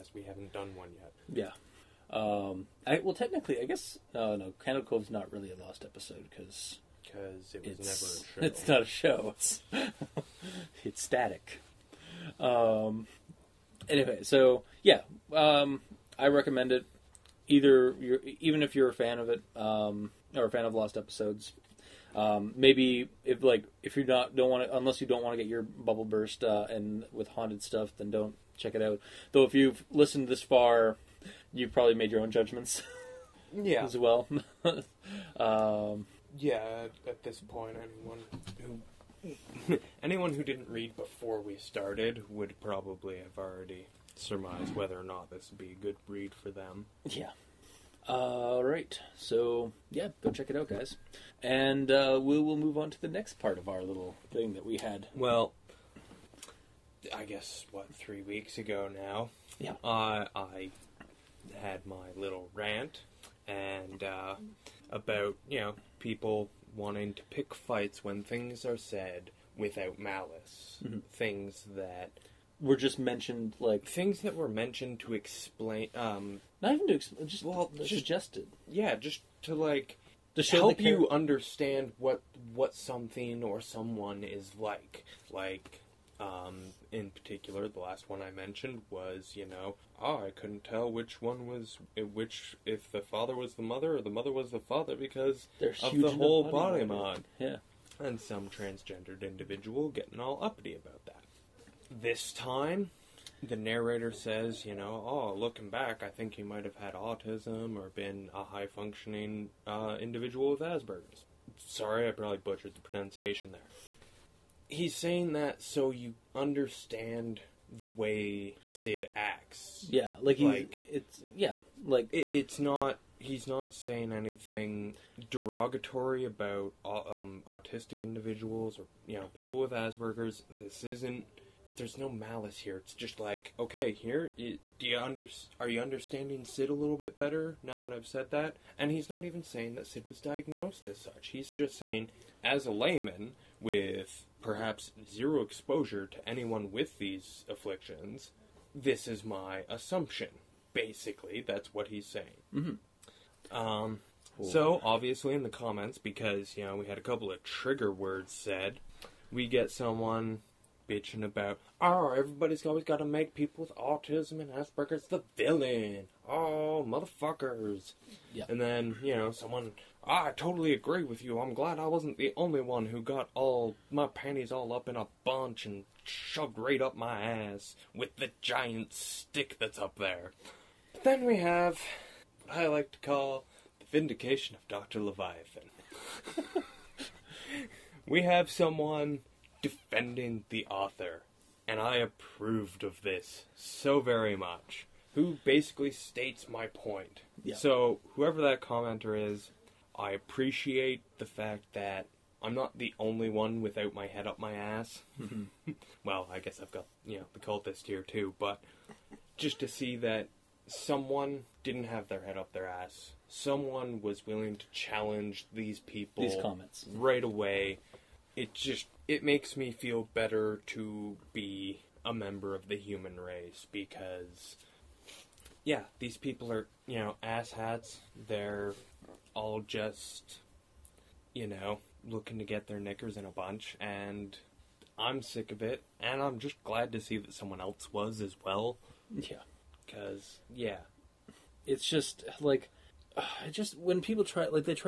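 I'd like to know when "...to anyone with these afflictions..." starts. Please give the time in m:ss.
2:26.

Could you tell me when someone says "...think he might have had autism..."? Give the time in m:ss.
1:46.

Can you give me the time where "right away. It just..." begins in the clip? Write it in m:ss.
3:36.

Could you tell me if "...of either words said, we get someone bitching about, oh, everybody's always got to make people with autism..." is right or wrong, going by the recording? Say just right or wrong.
wrong.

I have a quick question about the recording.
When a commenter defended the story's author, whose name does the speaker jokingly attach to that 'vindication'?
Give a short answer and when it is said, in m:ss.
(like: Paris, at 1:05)
Dr. Leviathan, at 3:04.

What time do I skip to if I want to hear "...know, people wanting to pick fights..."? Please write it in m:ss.
1:05.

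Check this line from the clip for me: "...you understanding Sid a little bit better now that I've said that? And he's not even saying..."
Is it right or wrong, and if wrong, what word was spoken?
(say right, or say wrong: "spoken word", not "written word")
right.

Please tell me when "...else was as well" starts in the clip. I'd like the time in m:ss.
3:57.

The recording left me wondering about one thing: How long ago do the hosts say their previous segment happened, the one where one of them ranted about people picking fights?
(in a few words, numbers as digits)
3 weeks.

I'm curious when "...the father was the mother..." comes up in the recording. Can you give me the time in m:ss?
1:32.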